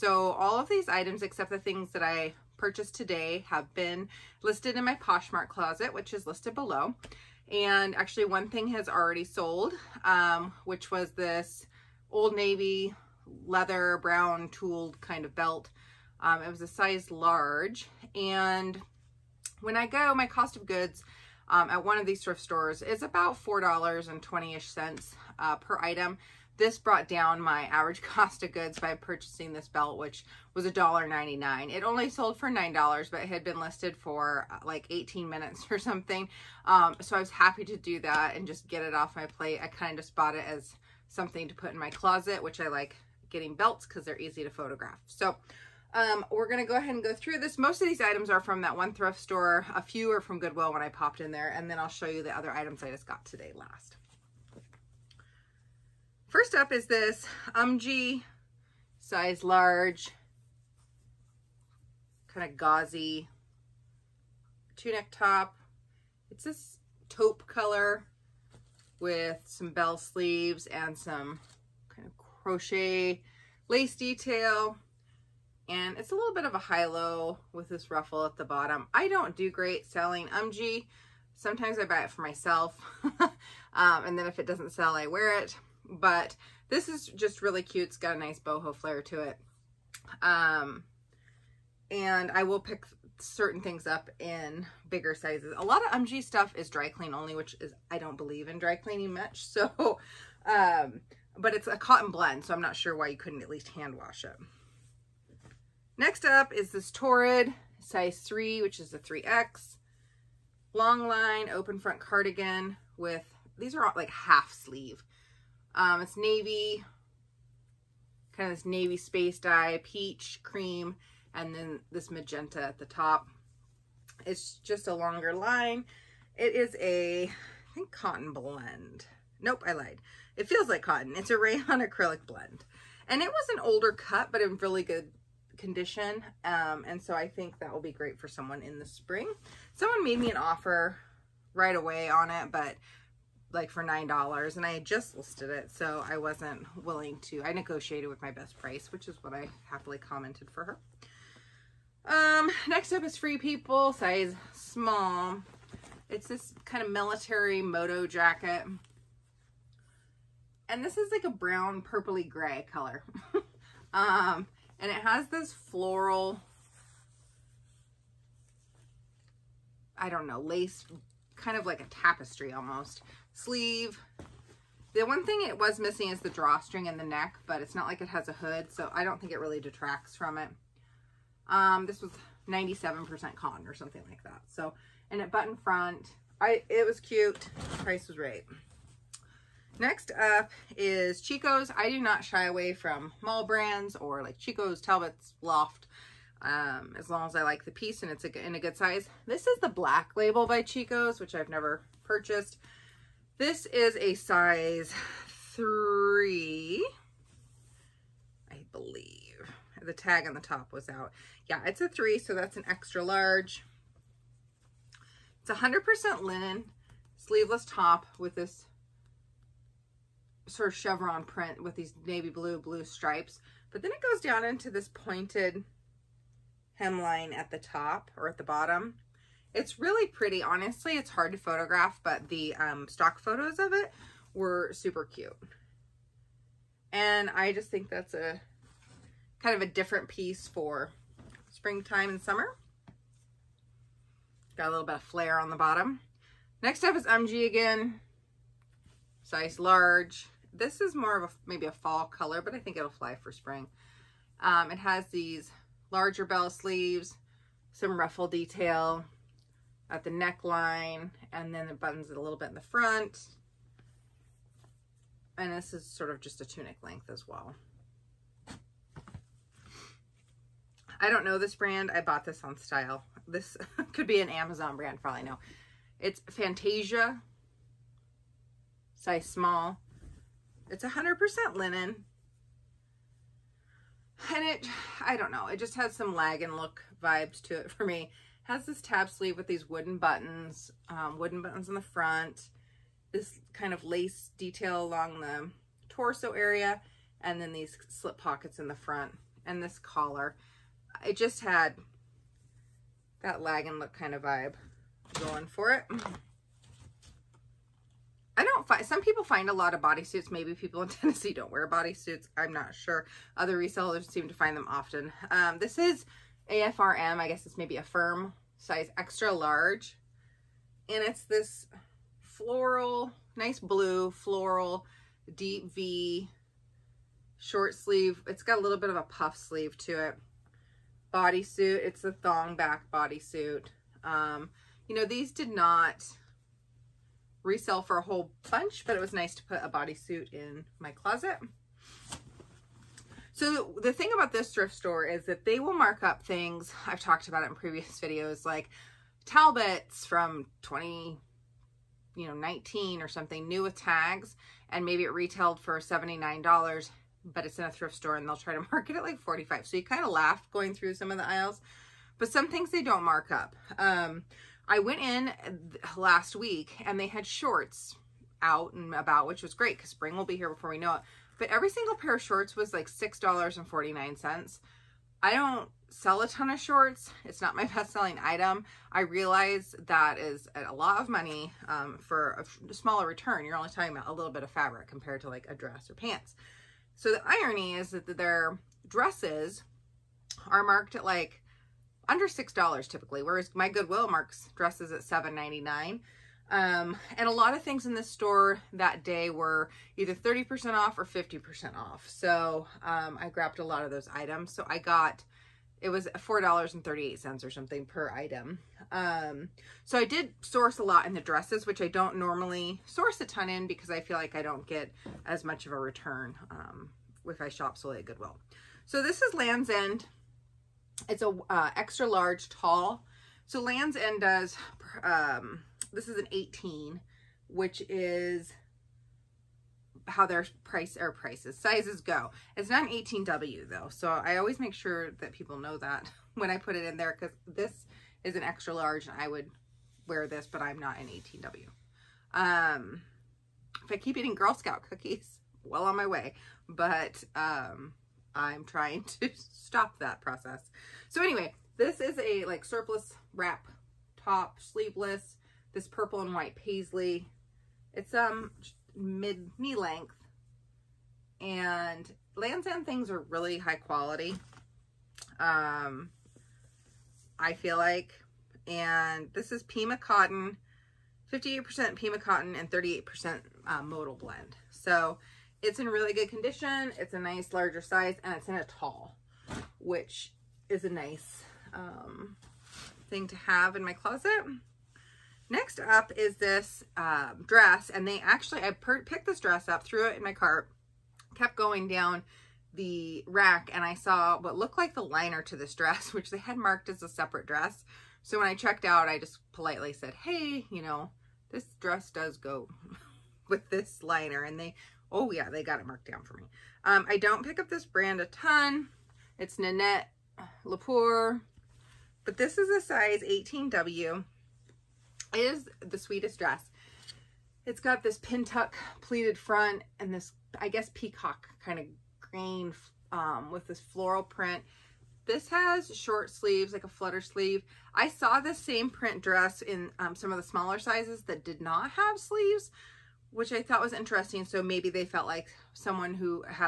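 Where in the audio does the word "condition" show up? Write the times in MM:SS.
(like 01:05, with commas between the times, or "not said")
02:15, 07:56.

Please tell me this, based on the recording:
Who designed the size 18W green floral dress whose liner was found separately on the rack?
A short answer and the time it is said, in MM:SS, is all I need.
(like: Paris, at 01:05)
Nanette Lepore, at 08:29.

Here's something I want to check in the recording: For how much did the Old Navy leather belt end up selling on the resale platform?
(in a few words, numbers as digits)
$9.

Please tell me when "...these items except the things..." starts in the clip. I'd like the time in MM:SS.
00:00.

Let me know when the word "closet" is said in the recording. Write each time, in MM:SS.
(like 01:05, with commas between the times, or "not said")
00:05, 00:41, 05:40, 08:03.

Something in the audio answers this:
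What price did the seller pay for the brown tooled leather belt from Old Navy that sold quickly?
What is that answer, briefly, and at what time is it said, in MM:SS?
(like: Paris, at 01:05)
$1.99, at 00:30.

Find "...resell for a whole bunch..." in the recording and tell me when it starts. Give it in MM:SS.
05:37.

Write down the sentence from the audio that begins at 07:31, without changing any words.
So anyway, this is a like surplus wrap top, sleeveless, this purple and white paisley.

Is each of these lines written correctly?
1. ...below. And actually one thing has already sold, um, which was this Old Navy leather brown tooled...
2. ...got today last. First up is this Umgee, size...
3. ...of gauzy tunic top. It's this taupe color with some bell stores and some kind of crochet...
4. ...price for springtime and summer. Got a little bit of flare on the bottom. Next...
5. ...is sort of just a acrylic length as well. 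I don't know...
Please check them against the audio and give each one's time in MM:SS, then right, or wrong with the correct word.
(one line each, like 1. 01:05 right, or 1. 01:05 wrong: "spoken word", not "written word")
1. 00:06 right
2. 00:53 right
3. 01:02 wrong: "sleeves", not "stores"
4. 04:00 wrong: "piece", not "price"
5. 04:25 wrong: "tunic", not "acrylic".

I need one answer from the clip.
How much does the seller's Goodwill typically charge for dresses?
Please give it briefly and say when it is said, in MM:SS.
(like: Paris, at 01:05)
$7.99, at 06:35.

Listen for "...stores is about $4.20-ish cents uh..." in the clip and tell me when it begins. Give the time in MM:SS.
00:22.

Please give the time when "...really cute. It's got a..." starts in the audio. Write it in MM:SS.
01:27.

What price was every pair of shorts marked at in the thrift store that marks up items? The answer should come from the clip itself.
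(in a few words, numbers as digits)
$6.49.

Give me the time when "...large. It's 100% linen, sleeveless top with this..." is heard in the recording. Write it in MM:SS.
03:33.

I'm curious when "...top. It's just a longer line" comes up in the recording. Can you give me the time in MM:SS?
02:02.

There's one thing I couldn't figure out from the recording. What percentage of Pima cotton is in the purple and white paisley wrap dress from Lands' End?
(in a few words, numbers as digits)
58%.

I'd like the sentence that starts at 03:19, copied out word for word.
This is the black label by Chico's, which I've never purchased.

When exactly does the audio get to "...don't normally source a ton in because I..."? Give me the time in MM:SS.
06:51.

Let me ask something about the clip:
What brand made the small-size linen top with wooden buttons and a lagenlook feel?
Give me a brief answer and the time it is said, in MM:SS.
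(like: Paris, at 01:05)
Fantasia, at 04:36.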